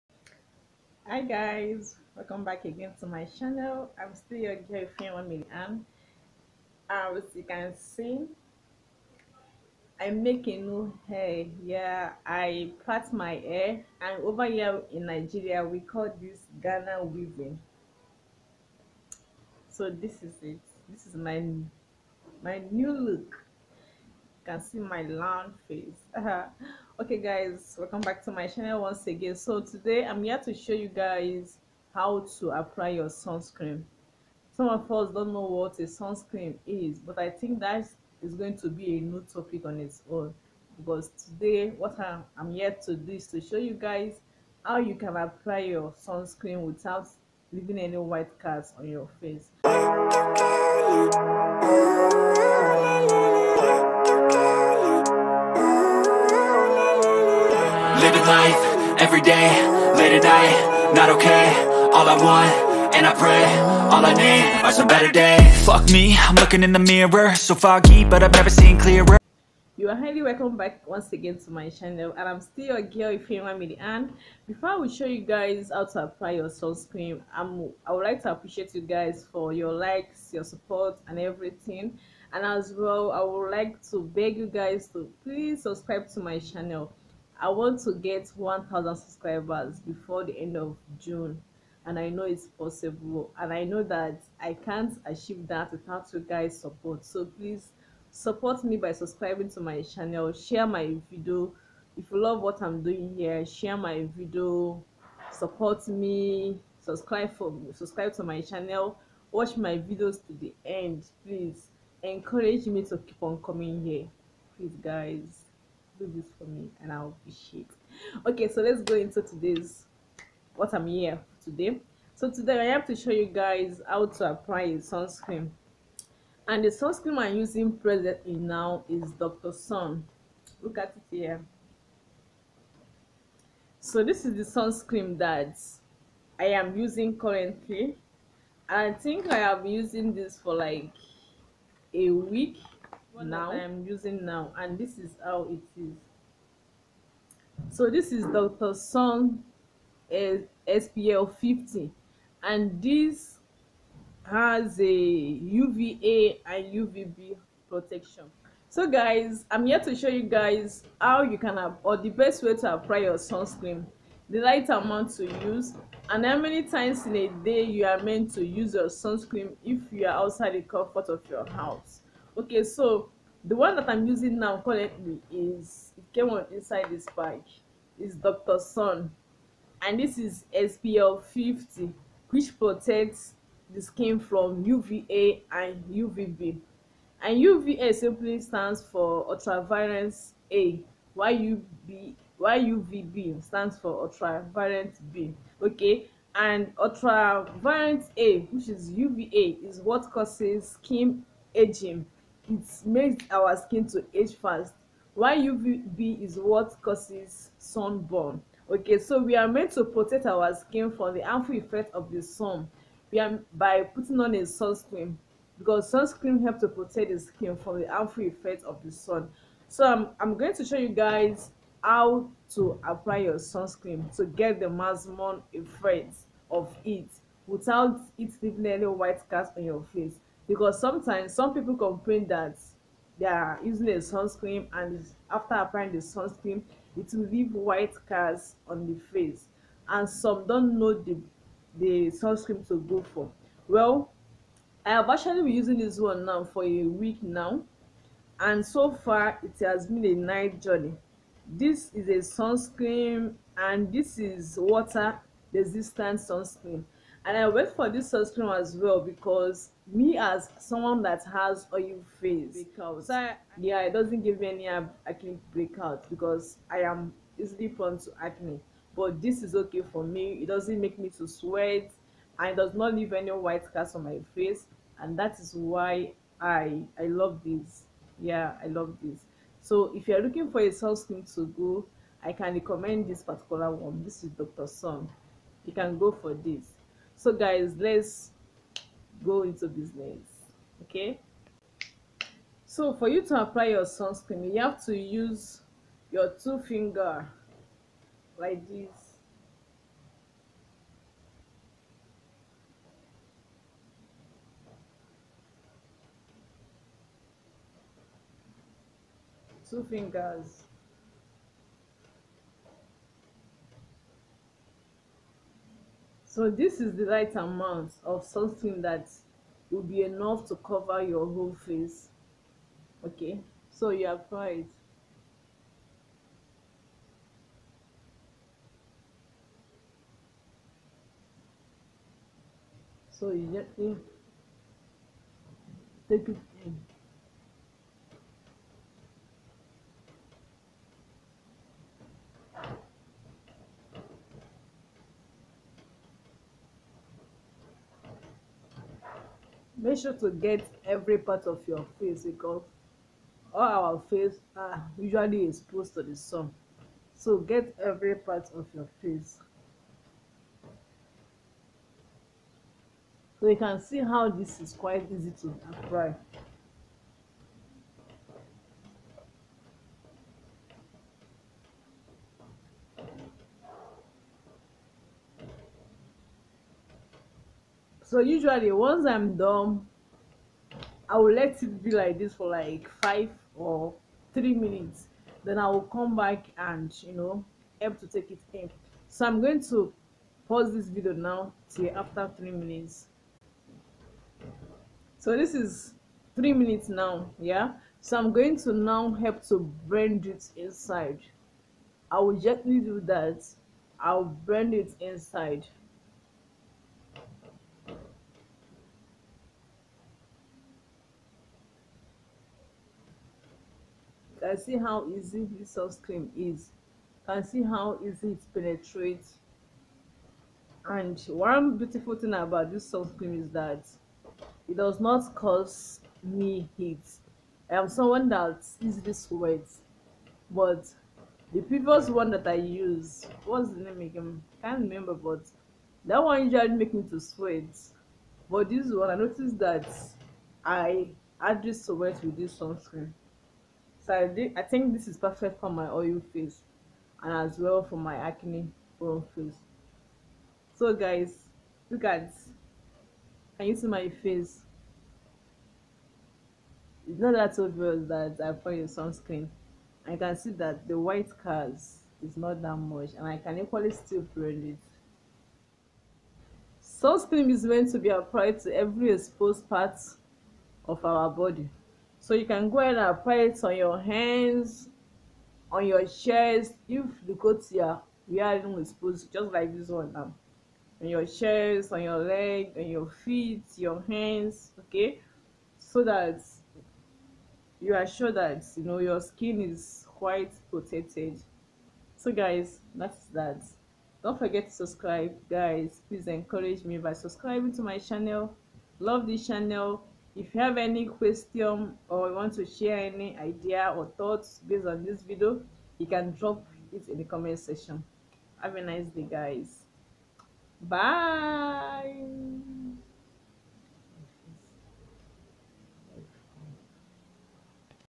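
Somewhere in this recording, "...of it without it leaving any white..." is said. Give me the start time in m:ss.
3:46.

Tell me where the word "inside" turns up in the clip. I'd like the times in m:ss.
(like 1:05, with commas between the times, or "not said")
2:56, 6:40, 6:44.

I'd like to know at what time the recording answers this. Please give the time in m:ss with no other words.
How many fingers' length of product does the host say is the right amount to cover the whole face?
4:56.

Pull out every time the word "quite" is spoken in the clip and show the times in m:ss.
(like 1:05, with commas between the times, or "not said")
6:04, 8:10.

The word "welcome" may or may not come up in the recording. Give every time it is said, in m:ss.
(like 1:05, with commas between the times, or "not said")
0:02, 0:27, 1:10.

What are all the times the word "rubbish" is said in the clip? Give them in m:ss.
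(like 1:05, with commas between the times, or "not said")
not said.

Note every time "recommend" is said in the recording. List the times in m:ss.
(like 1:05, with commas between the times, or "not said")
4:42.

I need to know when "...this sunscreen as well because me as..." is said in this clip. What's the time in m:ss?
4:17.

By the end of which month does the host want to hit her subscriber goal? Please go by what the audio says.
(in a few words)
June.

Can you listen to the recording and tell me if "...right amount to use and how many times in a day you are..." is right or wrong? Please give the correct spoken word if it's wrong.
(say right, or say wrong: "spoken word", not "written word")
right.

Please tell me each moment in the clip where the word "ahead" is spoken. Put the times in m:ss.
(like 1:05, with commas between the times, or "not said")
7:52.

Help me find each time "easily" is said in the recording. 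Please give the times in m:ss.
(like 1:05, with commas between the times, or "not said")
4:27, 7:08.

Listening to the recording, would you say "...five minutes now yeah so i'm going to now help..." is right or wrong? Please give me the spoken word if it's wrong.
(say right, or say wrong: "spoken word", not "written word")
wrong: "three", not "five".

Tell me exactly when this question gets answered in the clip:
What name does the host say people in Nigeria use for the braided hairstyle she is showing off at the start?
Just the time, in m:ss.
0:16.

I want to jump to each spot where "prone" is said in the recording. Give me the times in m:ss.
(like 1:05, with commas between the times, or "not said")
4:27, 7:28.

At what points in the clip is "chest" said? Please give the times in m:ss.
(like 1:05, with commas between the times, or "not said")
7:56, 8:01.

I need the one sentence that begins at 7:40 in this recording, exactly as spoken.
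I can see that the white cars is not that much and I can equally still blend it.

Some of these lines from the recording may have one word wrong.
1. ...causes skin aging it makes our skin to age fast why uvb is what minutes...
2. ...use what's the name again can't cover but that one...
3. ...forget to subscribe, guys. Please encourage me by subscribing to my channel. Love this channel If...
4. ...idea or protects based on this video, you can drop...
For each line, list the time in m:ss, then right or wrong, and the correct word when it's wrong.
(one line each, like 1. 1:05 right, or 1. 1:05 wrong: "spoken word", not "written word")
1. 3:20 wrong: "causes", not "minutes"
2. 7:12 wrong: "remember", not "cover"
3. 8:14 right
4. 8:23 wrong: "thoughts", not "protects".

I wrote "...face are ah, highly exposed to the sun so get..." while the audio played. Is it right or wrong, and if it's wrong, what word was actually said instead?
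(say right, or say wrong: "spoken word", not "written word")
wrong: "usually", not "highly".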